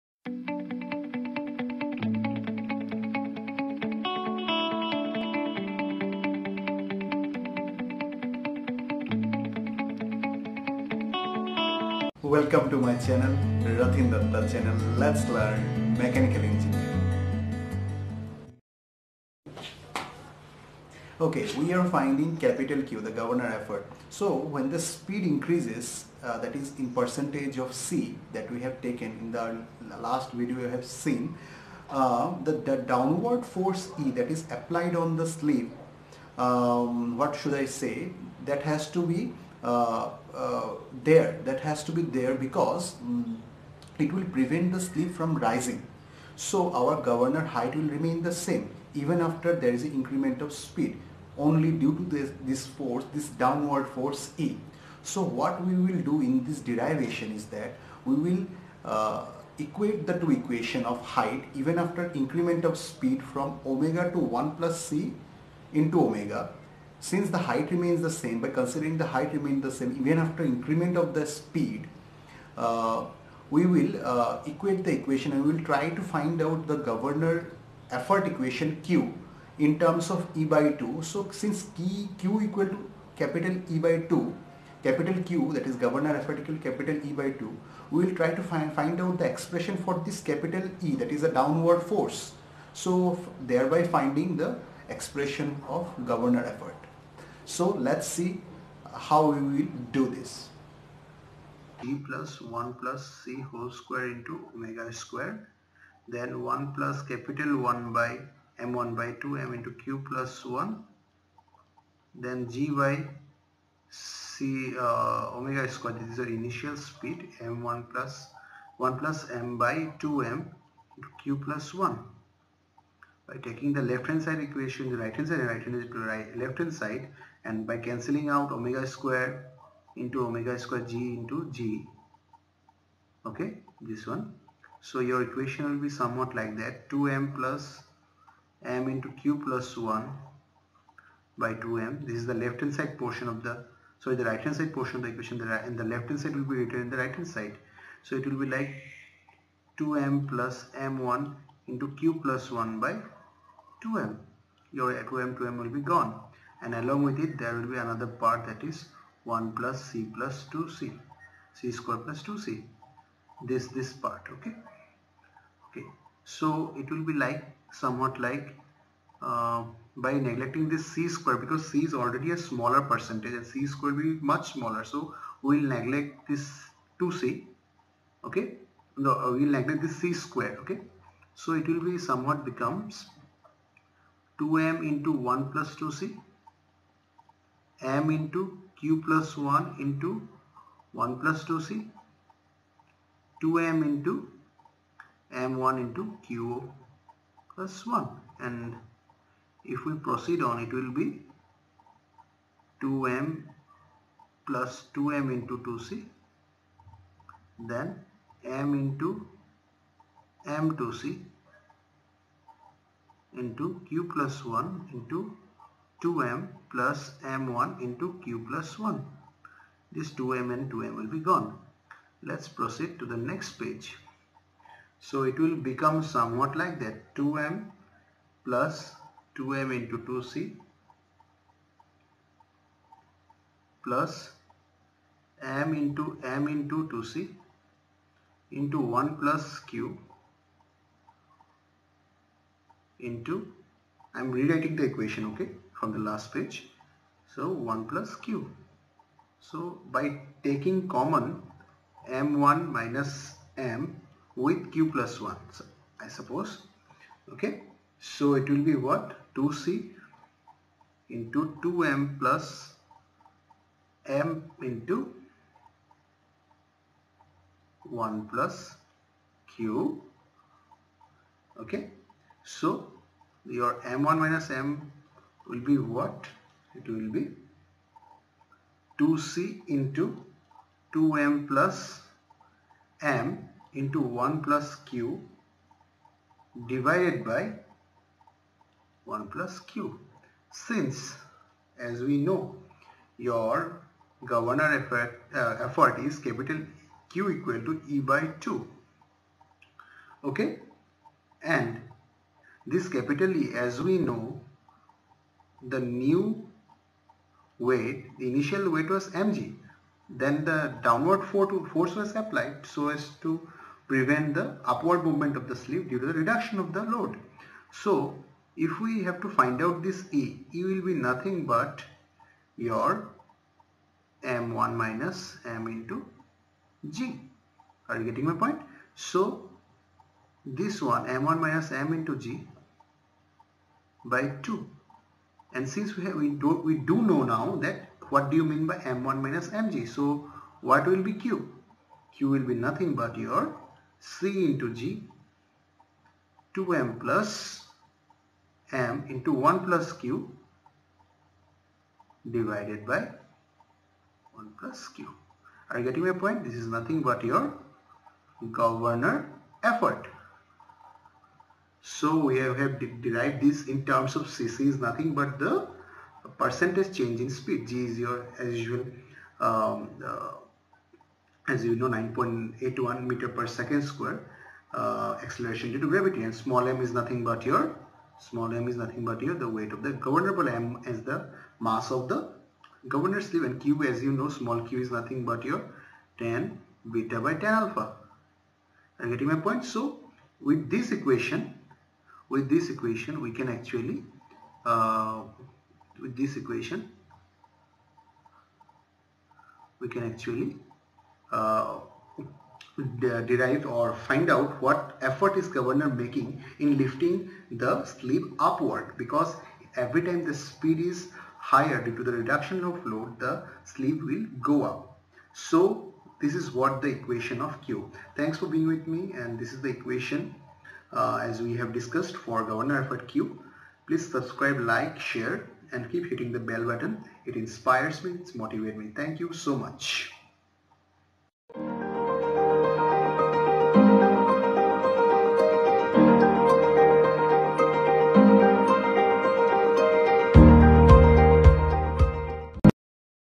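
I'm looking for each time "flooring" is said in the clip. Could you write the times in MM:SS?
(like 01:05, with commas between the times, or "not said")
not said.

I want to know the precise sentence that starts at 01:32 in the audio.
So thereby finding the expression of governor effort.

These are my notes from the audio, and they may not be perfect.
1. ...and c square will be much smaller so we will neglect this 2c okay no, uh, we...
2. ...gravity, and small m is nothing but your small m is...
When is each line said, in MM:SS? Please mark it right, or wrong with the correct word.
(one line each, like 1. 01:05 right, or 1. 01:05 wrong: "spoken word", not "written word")
1. 02:53 right
2. 06:15 right.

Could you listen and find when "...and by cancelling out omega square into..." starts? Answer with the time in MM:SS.
02:07.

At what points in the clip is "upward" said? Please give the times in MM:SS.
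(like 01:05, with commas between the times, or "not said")
05:14, 06:48.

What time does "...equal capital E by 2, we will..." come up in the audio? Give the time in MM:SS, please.
01:26.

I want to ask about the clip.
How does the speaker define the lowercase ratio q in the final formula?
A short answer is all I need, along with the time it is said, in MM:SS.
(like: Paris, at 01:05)
tan beta by tan alpha, at 06:26.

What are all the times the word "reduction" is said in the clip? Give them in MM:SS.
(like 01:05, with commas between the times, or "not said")
05:16, 06:52.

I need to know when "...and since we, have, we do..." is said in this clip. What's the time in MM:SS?
05:35.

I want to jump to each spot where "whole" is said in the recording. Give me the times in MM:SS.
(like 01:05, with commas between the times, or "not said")
01:43.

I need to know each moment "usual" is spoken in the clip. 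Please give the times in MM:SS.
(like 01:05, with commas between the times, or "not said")
06:08.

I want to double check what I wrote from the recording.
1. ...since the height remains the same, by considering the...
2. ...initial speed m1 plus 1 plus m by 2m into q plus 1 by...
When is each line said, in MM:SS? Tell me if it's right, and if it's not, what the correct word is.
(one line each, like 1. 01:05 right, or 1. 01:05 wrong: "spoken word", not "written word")
1. 01:07 right
2. 01:56 right.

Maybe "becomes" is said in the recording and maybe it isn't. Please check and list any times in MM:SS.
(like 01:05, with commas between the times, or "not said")
03:02, 03:45.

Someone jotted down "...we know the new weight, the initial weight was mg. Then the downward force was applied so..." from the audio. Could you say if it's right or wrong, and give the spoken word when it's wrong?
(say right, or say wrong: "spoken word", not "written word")
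right.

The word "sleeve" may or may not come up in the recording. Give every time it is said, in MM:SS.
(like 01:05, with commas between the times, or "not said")
00:35, 00:44, 05:15, 06:23, 06:47, 06:53.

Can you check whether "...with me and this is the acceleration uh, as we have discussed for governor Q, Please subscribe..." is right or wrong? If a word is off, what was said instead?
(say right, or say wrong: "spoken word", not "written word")
wrong: "equation", not "acceleration".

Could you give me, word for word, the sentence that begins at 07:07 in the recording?
It inspires me, it motivates me.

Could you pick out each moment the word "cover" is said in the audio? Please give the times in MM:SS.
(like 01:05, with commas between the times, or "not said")
not said.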